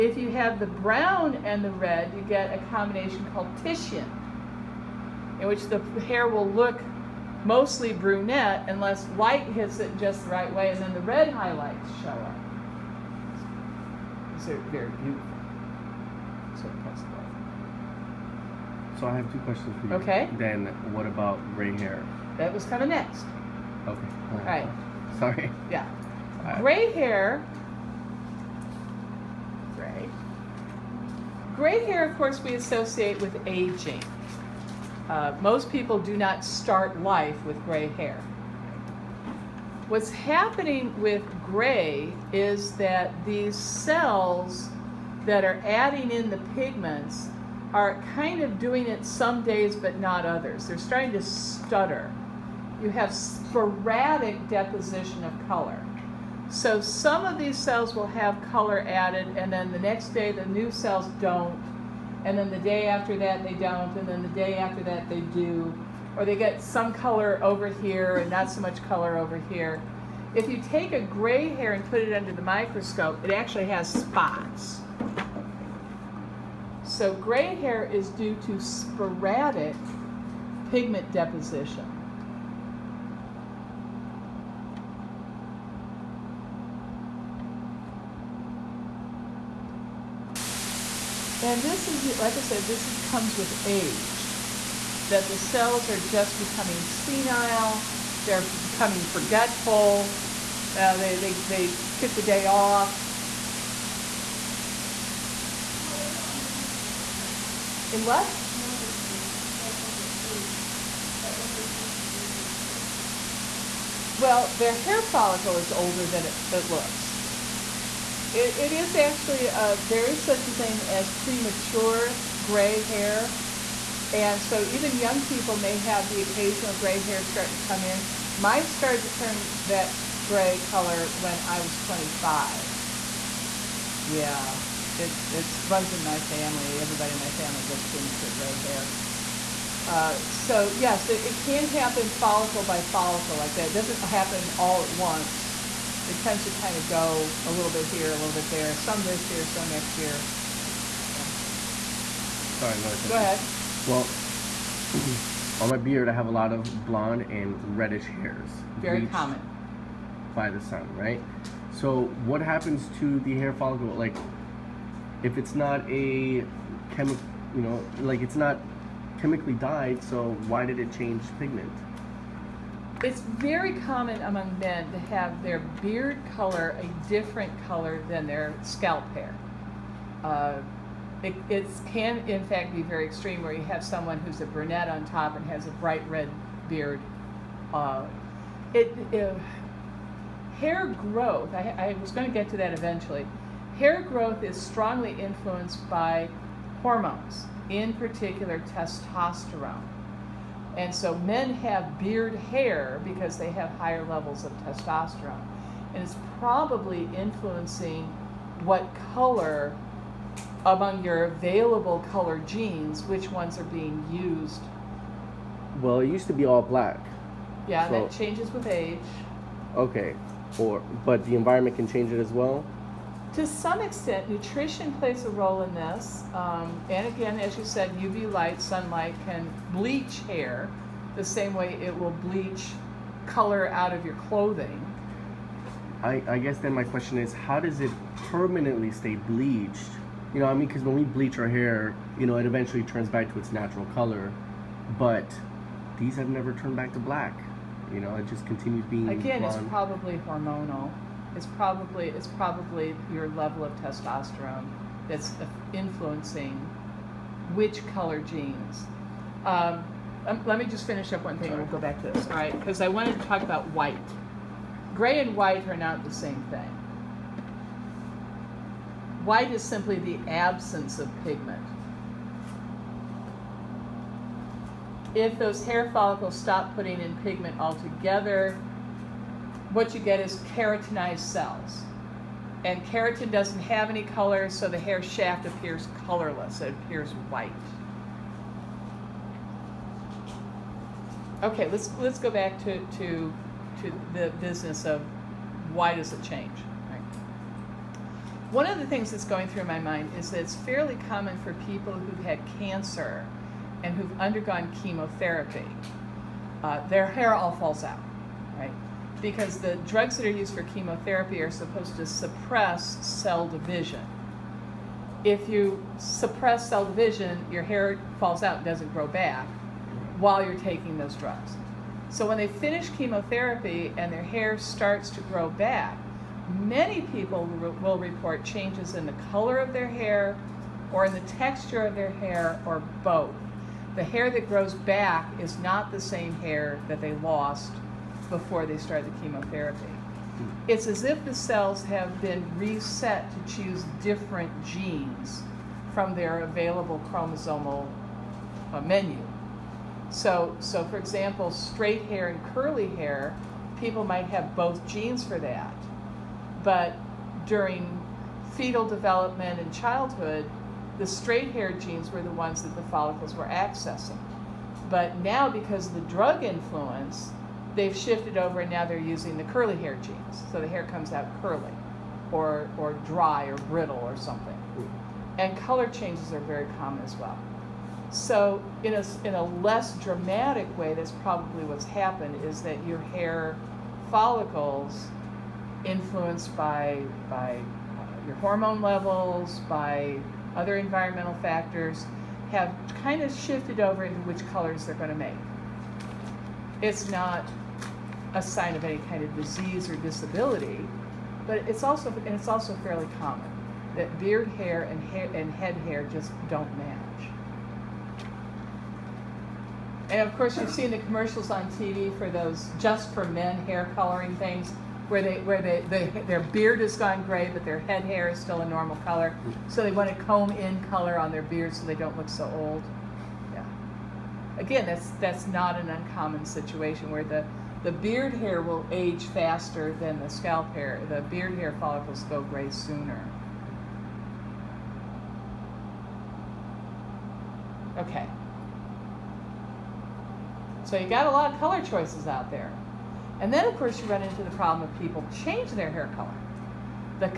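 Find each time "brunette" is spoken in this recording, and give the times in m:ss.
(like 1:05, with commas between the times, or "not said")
0:07, 3:04.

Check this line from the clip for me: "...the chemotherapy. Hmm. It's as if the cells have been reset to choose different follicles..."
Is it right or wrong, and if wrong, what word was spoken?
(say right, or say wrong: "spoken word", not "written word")
wrong: "genes", not "follicles".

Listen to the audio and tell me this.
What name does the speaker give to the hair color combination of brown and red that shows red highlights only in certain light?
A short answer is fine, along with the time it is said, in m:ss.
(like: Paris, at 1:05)
Titian, at 0:03.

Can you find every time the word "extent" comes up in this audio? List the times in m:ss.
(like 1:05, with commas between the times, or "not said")
3:43.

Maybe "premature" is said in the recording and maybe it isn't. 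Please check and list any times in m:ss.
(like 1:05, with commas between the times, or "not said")
2:01, 2:17.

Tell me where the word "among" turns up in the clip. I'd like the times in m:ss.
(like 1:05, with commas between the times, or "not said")
2:54, 3:30.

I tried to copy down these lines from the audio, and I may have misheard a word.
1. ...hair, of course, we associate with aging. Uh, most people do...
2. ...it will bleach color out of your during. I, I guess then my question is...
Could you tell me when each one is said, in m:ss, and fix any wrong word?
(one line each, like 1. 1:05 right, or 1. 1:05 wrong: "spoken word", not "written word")
1. 0:31 right
2. 3:51 wrong: "clothing", not "during".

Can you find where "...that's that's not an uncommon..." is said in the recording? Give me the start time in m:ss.
7:04.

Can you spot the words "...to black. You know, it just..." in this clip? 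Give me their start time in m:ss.
4:06.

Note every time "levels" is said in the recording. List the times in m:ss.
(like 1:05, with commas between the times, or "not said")
3:24, 4:13, 6:28.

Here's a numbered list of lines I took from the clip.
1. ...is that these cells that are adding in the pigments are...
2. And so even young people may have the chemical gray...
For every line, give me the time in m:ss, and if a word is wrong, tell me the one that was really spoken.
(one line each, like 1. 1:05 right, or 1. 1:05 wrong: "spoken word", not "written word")
1. 0:42 right
2. 2:04 wrong: "occasional", not "chemical".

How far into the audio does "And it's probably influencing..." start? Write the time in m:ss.
3:25.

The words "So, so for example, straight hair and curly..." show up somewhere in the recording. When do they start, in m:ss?
5:50.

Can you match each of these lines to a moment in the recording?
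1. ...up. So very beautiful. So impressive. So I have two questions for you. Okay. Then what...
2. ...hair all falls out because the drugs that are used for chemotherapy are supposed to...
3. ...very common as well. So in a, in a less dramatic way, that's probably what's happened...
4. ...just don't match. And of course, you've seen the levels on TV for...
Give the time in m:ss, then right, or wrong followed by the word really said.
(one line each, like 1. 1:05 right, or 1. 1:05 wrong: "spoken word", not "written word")
1. 0:12 right
2. 5:07 right
3. 6:16 right
4. 6:46 wrong: "commercials", not "levels".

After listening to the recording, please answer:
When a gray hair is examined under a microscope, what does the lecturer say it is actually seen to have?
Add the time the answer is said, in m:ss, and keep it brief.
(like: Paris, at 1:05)
Spots, at 1:13.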